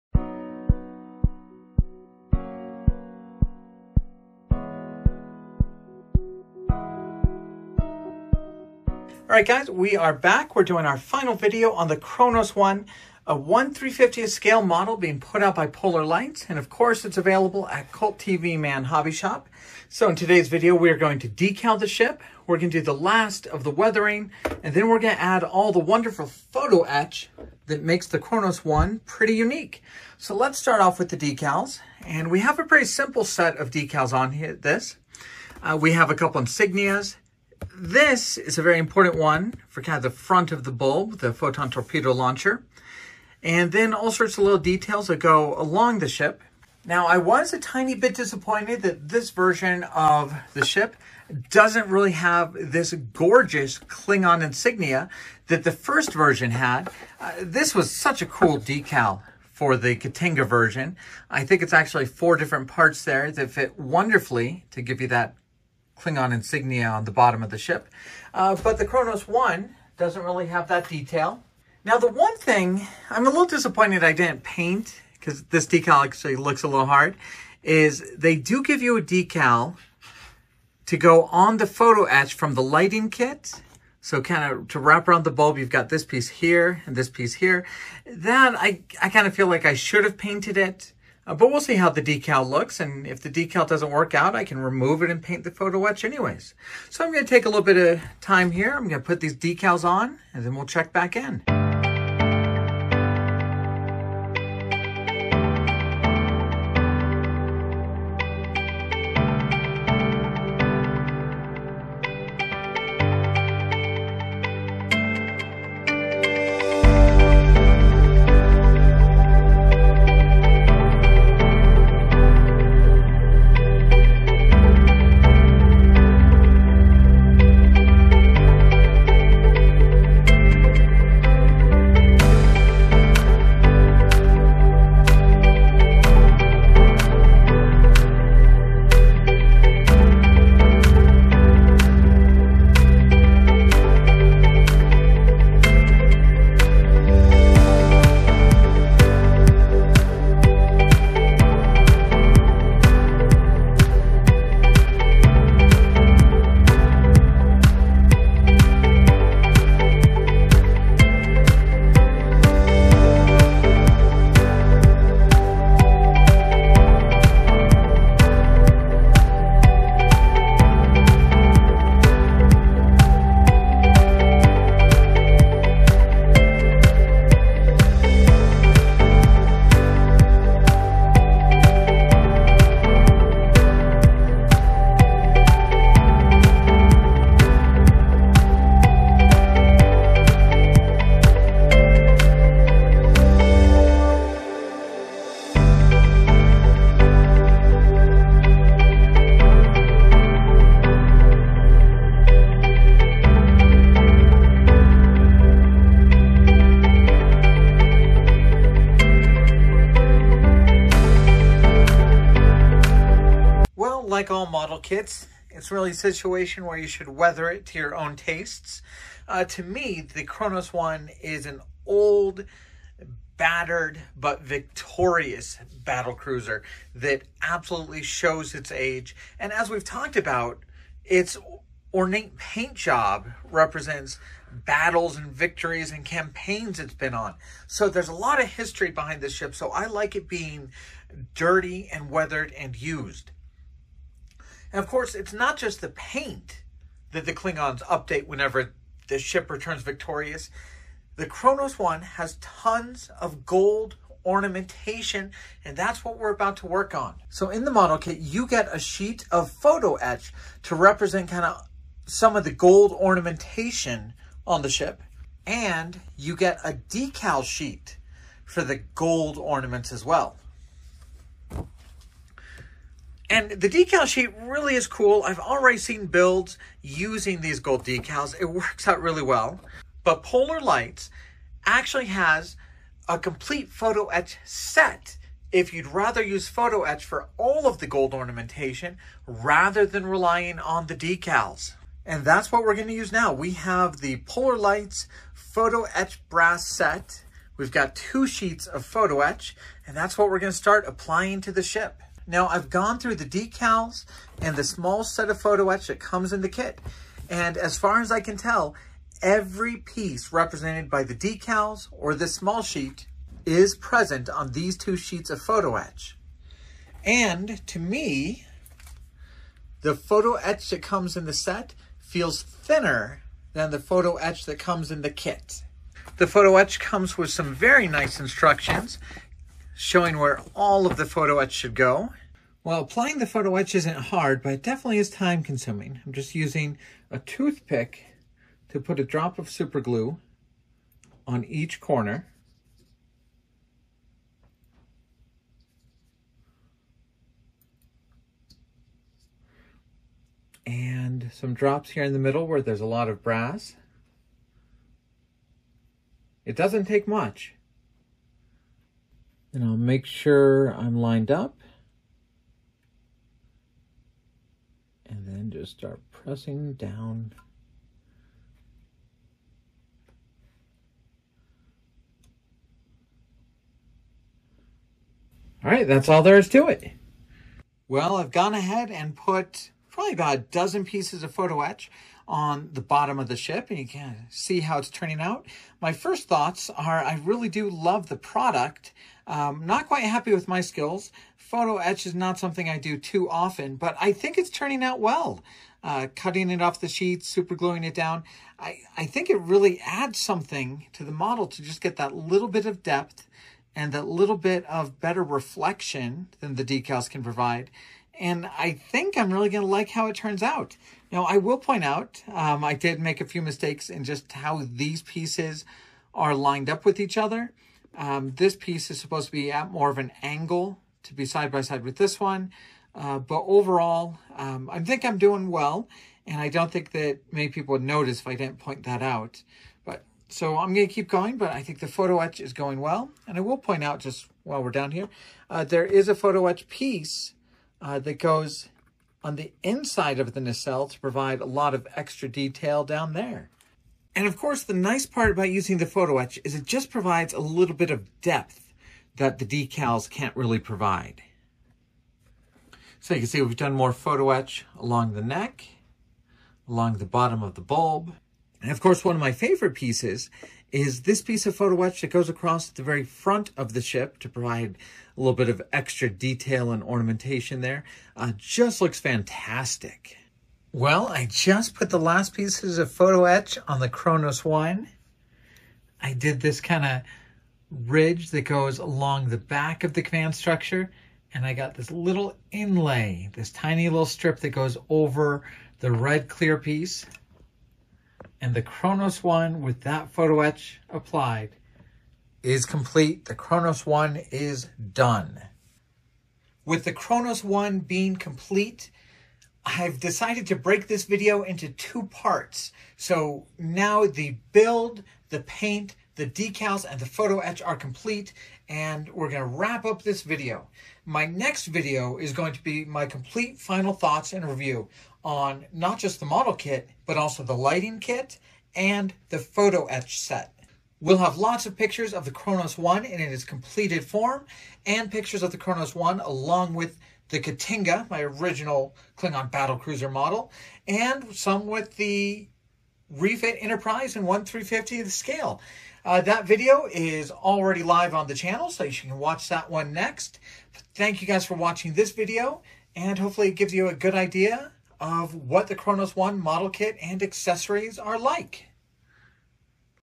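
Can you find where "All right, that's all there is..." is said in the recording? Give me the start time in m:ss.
6:15.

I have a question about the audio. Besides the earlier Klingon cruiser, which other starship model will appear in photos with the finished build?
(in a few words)
Refit Enterprise.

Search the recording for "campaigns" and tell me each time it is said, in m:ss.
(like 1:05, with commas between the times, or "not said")
3:56.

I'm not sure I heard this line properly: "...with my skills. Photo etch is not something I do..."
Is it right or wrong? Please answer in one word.
right.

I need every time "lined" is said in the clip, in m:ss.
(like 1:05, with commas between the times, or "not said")
6:00, 6:56.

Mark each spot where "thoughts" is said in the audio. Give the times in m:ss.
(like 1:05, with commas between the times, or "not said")
6:26, 8:33.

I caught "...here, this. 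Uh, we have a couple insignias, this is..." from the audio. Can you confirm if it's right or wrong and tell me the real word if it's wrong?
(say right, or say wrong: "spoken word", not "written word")
right.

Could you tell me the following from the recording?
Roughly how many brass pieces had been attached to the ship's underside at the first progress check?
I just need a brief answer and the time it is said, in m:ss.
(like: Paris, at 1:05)
about a dozen, at 6:20.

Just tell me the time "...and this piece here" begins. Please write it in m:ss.
1:26.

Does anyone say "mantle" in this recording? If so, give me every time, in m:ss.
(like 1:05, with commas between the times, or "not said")
not said.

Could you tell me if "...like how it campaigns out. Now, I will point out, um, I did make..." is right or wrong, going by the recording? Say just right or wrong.
wrong.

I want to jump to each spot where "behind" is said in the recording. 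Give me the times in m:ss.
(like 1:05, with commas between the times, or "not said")
3:58.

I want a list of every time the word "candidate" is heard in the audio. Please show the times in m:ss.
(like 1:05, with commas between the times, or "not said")
not said.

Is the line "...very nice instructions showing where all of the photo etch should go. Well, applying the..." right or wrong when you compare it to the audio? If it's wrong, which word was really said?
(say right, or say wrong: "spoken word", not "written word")
right.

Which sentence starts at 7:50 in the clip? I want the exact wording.
Well, I just put the last pieces of photo etch on the Kronos One.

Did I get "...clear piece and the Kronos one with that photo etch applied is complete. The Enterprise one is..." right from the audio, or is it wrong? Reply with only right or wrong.
wrong.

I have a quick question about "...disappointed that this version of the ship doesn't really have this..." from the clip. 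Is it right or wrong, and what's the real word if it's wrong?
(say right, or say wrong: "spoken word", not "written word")
right.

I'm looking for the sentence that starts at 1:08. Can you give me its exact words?
Uh, but the Kronos 1 doesn't really have that detail.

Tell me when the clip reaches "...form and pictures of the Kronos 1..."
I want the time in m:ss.
8:44.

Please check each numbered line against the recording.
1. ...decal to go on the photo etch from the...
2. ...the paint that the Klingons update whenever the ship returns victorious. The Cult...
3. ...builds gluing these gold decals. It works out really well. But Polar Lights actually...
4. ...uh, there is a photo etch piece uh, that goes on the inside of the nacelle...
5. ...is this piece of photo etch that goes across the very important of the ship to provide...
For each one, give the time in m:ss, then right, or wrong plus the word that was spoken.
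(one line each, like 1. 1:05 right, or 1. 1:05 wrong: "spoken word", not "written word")
1. 1:19 right
2. 4:05 wrong: "Kronos", not "Cult"
3. 4:36 wrong: "using", not "gluing"
4. 7:15 right
5. 7:40 wrong: "front", not "important".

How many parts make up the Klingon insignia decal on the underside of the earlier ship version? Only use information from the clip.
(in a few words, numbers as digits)
4.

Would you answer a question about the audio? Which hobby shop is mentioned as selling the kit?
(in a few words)
Cult TV Man Hobby Shop.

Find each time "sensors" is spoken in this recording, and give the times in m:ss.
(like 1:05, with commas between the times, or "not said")
not said.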